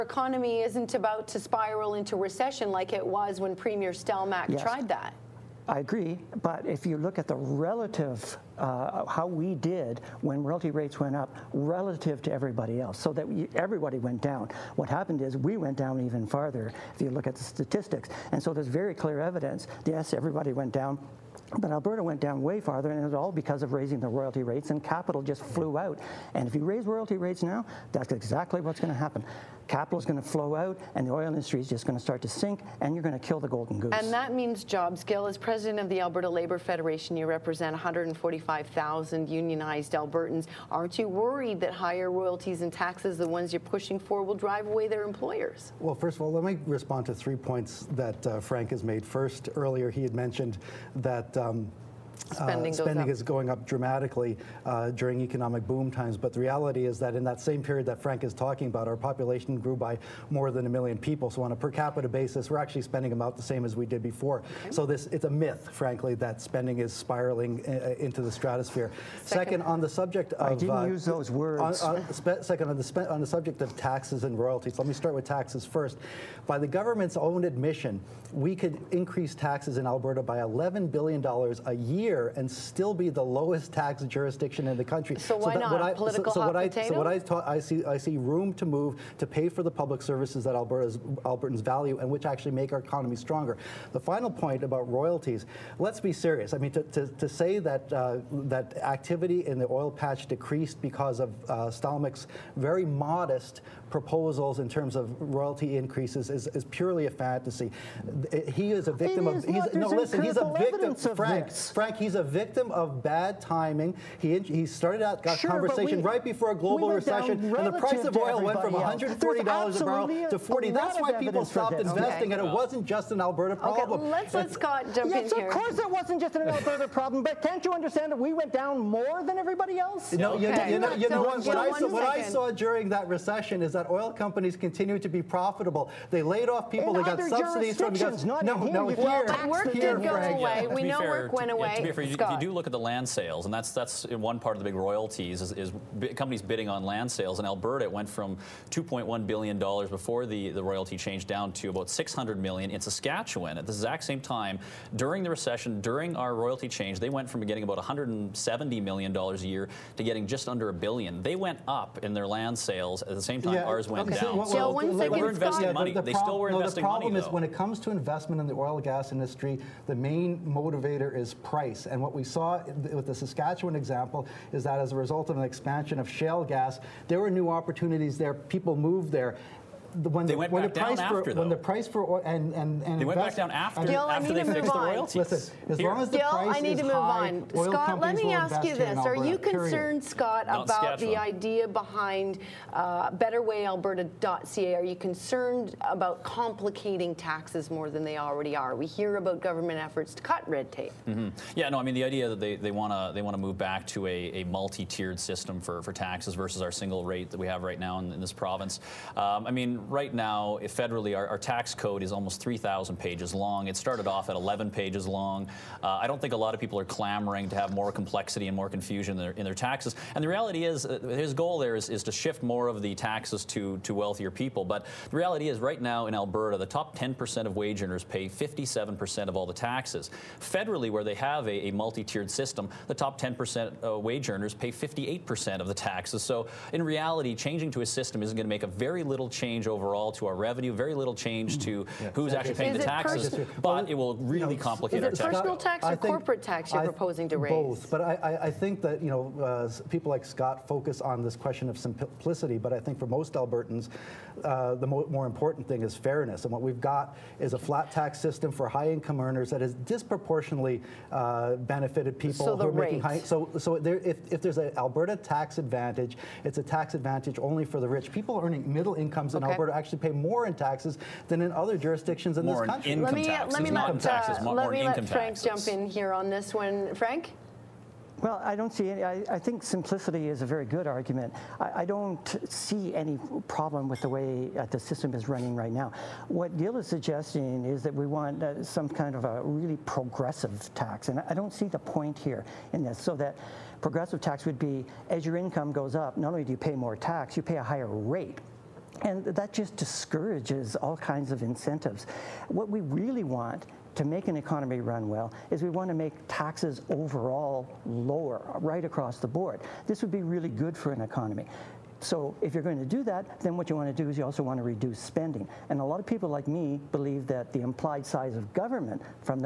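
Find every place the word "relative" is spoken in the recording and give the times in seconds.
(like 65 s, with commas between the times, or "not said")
7 s, 11 s.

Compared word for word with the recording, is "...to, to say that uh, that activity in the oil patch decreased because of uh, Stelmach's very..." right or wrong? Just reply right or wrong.
right.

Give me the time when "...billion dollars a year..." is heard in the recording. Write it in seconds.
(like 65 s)
80 s.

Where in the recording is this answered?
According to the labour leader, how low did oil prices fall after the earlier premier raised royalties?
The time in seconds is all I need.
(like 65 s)
120 s.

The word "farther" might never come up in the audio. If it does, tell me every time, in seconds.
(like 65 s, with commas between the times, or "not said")
16 s, 22 s.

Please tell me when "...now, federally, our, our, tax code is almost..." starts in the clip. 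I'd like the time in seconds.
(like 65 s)
210 s.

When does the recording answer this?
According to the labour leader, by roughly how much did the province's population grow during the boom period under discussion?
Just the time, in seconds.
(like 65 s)
60 s.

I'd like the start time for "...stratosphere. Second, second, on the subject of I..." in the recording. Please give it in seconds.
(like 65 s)
68 s.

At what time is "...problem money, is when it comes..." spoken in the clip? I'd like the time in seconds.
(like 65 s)
166 s.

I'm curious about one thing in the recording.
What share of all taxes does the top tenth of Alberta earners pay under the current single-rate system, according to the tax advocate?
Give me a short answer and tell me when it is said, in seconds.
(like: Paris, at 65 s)
57%, at 228 s.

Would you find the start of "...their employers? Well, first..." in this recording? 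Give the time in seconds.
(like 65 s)
44 s.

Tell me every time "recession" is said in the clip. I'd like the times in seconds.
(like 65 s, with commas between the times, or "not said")
2 s, 116 s, 133 s, 155 s.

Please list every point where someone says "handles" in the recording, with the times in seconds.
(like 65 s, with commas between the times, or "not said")
not said.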